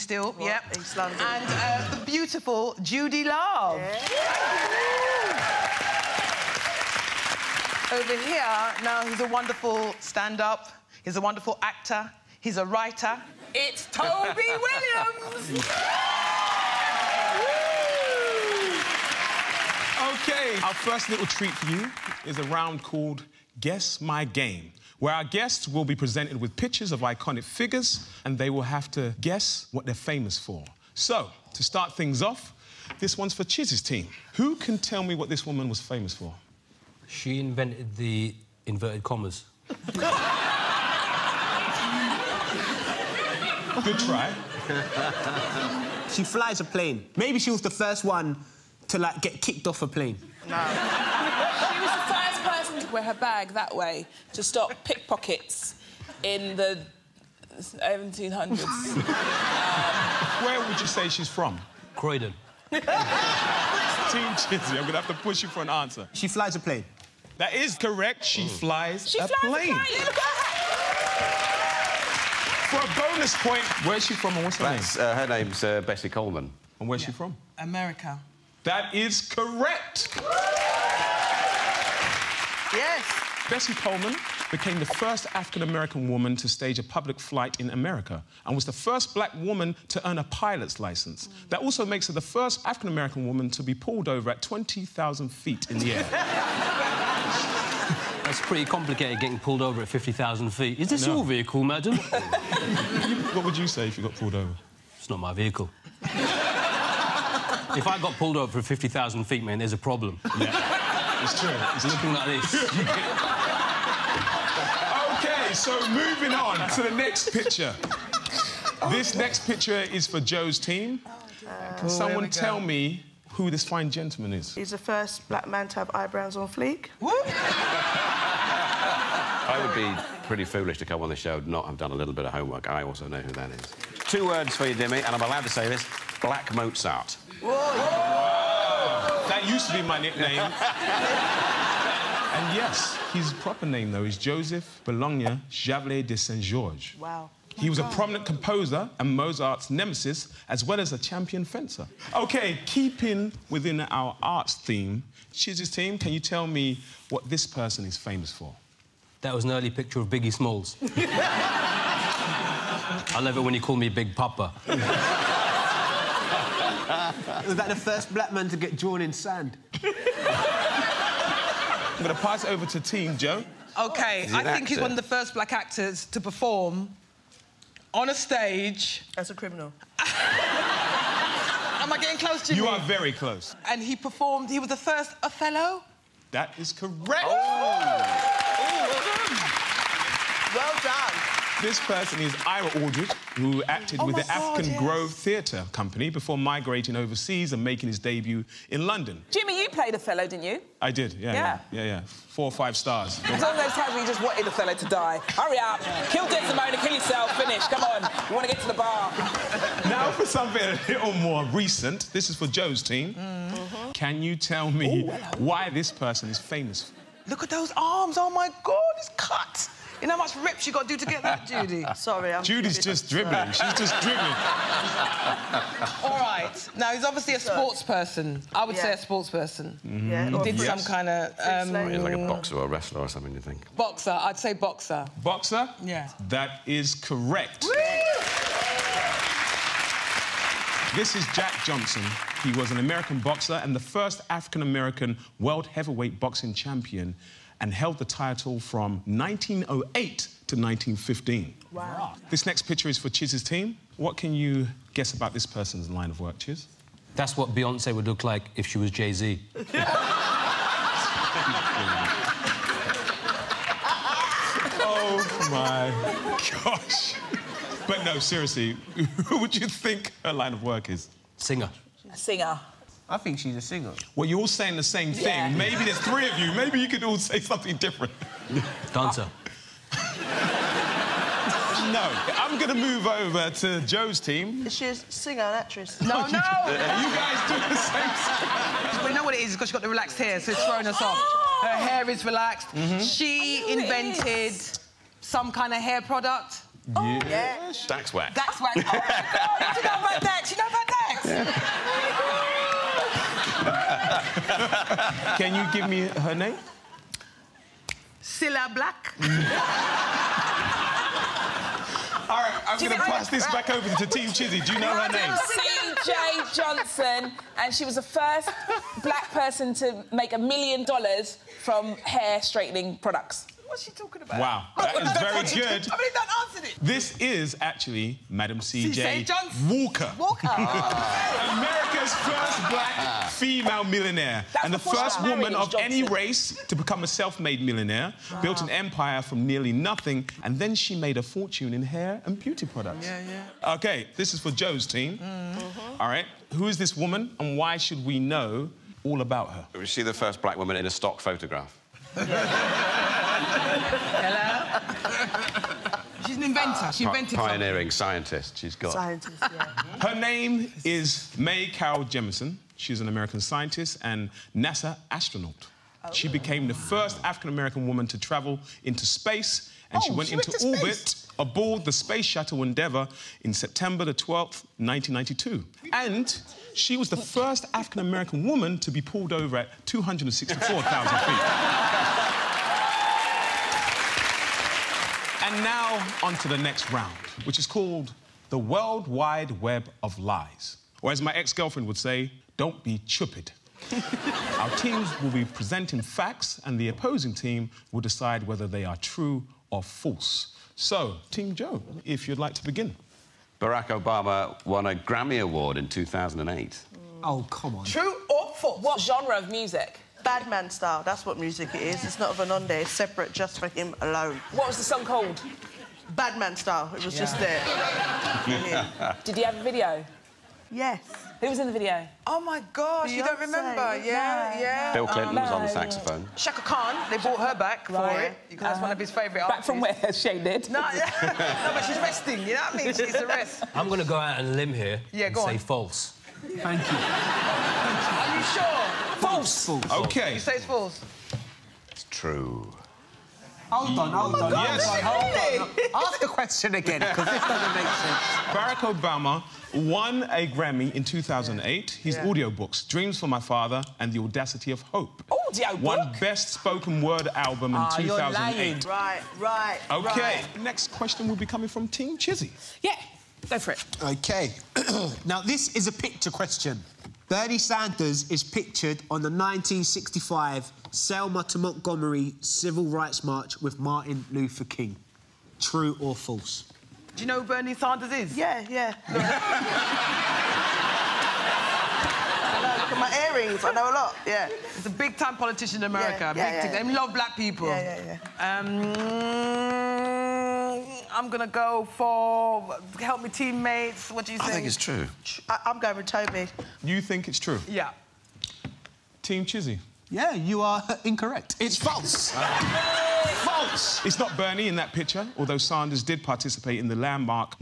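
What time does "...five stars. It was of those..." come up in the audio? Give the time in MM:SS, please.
03:22.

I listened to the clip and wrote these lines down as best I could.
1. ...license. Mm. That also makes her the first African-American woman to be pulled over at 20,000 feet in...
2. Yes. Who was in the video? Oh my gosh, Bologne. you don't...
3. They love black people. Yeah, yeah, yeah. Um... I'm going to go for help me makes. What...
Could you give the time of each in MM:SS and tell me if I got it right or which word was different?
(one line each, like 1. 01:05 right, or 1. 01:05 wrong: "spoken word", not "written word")
1. 01:30 right
2. 07:00 wrong: "Beyonce", not "Bologne"
3. 08:06 wrong: "teammates", not "makes".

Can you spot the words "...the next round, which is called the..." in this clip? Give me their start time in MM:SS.
06:26.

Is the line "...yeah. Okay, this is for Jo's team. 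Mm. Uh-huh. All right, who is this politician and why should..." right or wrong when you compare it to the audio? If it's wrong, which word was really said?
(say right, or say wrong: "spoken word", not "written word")
wrong: "woman", not "politician".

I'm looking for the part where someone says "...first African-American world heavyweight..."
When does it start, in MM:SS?
04:03.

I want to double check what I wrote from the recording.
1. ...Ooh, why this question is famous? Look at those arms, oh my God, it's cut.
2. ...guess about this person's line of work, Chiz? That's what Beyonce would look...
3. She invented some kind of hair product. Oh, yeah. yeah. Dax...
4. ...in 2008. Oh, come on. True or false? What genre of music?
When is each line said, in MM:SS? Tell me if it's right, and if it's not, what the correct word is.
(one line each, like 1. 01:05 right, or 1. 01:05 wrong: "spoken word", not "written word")
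1. 03:35 wrong: "person", not "question"
2. 04:14 right
3. 04:53 right
4. 06:45 right.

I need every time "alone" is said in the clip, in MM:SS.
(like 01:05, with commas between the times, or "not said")
06:54.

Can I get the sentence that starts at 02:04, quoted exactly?
He's the first black man to have eyebrows on fleek.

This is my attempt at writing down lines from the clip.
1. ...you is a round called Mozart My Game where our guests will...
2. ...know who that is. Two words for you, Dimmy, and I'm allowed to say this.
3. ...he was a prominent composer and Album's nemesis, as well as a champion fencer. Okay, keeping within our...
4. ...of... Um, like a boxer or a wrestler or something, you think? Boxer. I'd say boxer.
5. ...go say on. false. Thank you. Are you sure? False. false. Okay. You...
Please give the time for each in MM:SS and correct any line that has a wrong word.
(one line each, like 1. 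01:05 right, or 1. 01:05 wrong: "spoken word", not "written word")
1. 00:21 wrong: "Guess", not "Mozart"
2. 02:13 right
3. 02:27 wrong: "Mozart", not "Album"
4. 03:51 right
5. 07:15 right.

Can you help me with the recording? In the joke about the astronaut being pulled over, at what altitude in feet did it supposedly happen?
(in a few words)
264,000 feet.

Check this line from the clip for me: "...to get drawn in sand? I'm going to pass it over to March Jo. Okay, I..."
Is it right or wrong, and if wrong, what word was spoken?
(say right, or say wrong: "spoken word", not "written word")
wrong: "Team", not "March".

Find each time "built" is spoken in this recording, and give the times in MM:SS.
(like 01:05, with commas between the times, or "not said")
05:38.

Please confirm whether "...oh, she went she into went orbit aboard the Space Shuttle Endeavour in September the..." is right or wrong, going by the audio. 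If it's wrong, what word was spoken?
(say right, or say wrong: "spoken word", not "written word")
right.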